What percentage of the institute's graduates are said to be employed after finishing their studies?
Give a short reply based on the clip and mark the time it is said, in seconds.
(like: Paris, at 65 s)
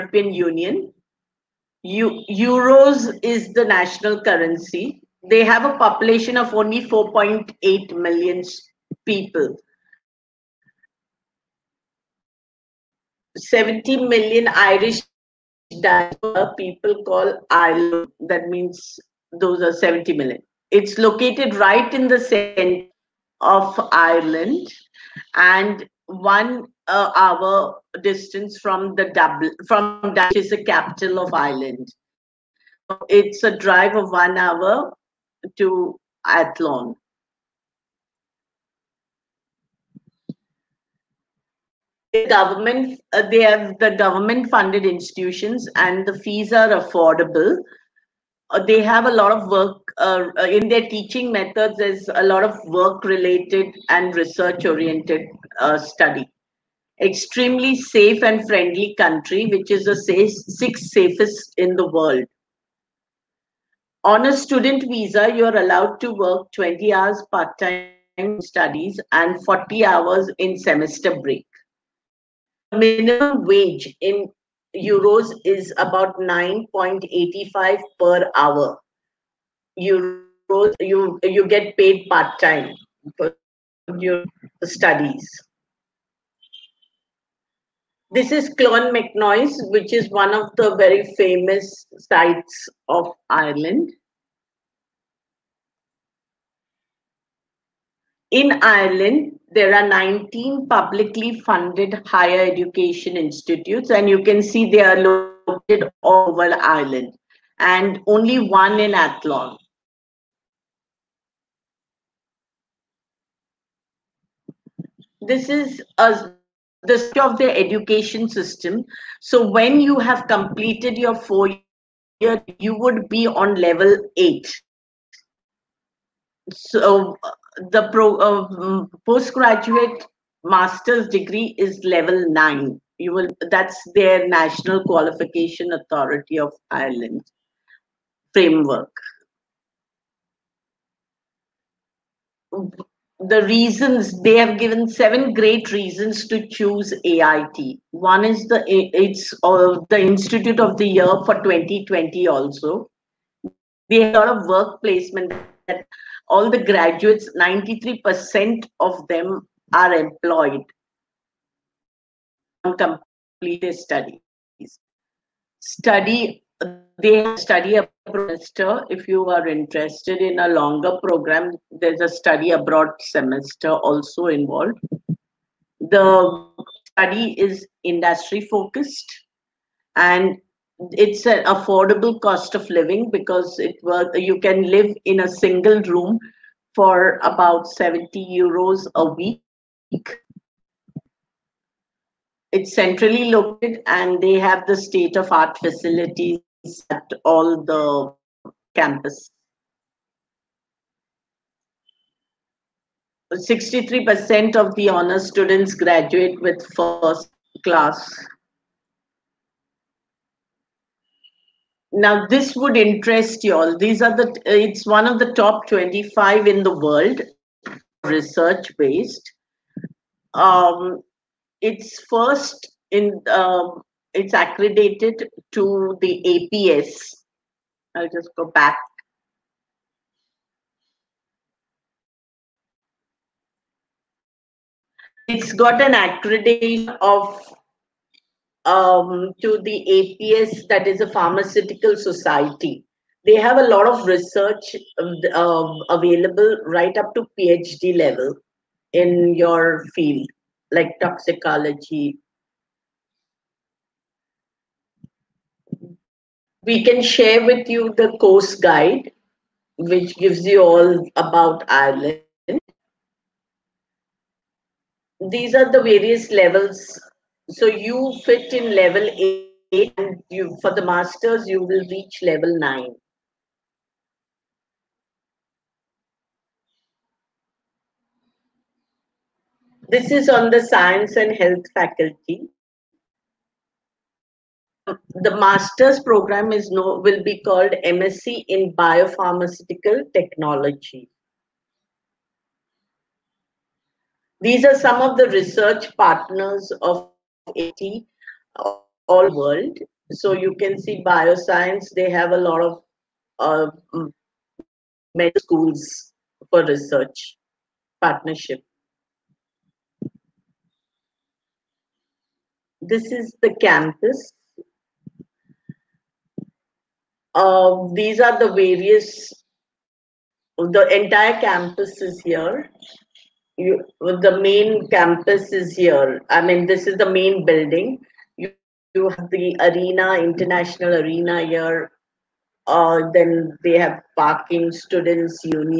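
93%, at 157 s.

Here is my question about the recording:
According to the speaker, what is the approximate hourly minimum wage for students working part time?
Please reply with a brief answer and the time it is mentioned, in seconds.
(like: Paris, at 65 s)
9.85 euros, at 76 s.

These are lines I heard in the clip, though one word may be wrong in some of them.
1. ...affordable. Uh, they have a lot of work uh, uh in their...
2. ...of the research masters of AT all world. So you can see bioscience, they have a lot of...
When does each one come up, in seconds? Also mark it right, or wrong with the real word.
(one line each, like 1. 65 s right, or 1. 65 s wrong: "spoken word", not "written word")
1. 46 s right
2. 294 s wrong: "partners", not "masters".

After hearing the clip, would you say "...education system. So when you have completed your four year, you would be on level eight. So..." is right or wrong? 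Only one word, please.
right.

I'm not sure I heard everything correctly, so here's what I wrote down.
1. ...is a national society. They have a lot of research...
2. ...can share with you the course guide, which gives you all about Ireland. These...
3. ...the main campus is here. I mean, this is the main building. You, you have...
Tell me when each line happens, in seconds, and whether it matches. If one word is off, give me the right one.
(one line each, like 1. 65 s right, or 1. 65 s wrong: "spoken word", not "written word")
1. 240 s wrong: "pharmaceutical", not "national"
2. 256 s right
3. 324 s right.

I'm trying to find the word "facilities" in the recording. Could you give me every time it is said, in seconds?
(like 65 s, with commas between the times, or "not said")
195 s.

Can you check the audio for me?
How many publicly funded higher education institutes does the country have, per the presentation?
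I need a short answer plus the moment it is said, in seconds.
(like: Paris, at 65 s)
19, at 99 s.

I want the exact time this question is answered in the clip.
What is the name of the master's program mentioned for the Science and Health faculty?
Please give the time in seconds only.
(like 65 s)
287 s.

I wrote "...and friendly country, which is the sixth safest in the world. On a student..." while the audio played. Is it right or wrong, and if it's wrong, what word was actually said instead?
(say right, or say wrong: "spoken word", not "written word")
right.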